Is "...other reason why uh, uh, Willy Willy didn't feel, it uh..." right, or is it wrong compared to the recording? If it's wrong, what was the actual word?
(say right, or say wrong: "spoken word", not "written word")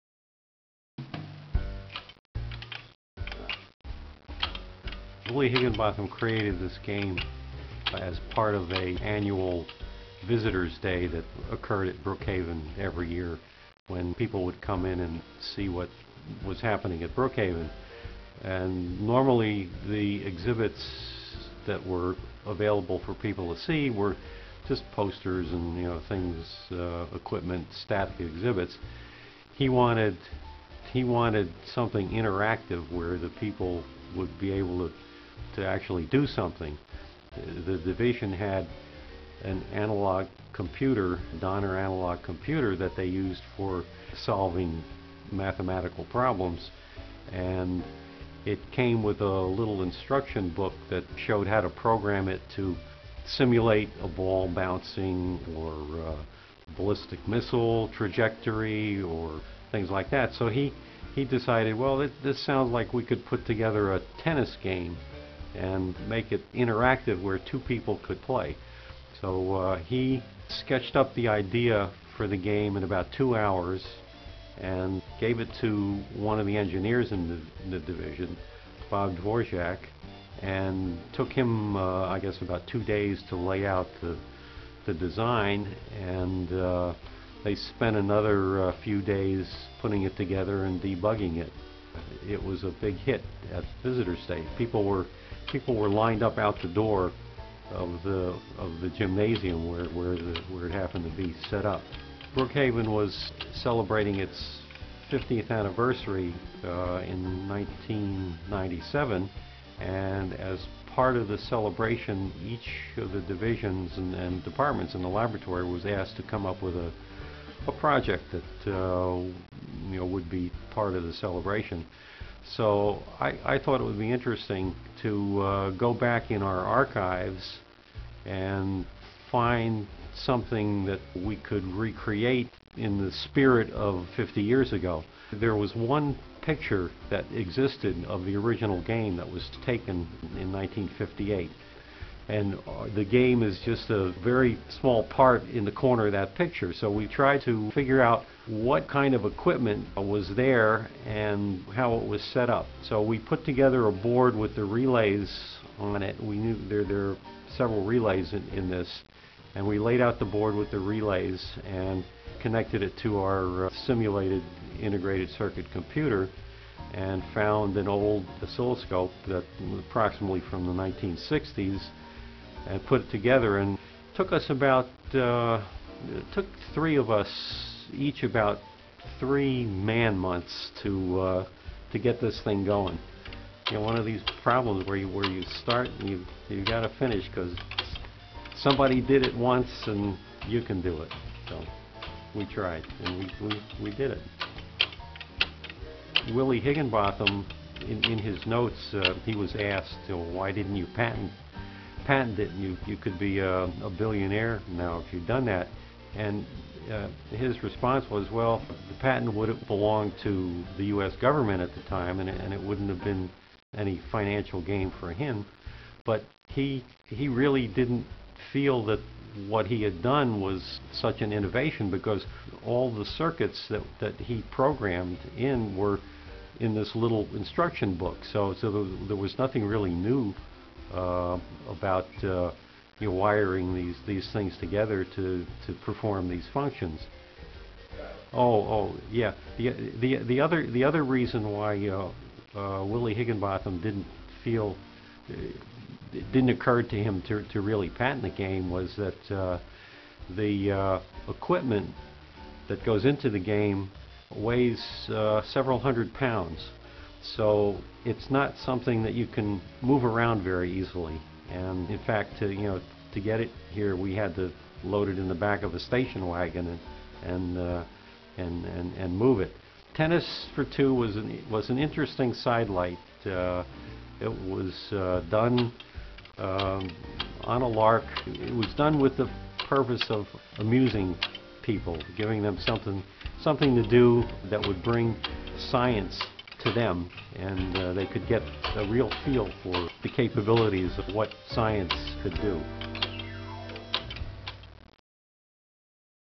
wrong: "Higinbotham", not "Willy".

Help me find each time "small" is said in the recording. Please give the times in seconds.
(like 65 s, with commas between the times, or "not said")
144 s.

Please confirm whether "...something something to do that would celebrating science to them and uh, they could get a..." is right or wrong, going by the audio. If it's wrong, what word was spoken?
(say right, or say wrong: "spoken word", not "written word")
wrong: "bring", not "celebrating".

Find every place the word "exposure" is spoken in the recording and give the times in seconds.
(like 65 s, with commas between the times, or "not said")
not said.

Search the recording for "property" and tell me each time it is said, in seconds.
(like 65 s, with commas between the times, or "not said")
not said.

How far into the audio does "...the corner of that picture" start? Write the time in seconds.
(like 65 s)
145 s.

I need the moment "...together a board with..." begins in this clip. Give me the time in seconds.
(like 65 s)
153 s.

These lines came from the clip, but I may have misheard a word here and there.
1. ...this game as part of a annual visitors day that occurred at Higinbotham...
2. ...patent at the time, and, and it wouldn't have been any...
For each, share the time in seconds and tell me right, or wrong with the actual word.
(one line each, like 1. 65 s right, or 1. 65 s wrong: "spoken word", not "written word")
1. 6 s wrong: "Brookhaven", not "Higinbotham"
2. 211 s wrong: "government", not "patent".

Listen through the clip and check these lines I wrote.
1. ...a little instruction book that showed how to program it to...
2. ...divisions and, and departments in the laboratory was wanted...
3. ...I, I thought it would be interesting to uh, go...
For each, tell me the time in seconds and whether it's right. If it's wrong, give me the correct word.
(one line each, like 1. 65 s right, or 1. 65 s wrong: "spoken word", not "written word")
1. 49 s right
2. 113 s wrong: "asked", not "wanted"
3. 123 s right.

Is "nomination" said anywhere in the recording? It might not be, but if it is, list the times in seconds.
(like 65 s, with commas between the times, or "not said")
not said.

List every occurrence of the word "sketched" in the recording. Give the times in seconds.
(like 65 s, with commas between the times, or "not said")
70 s.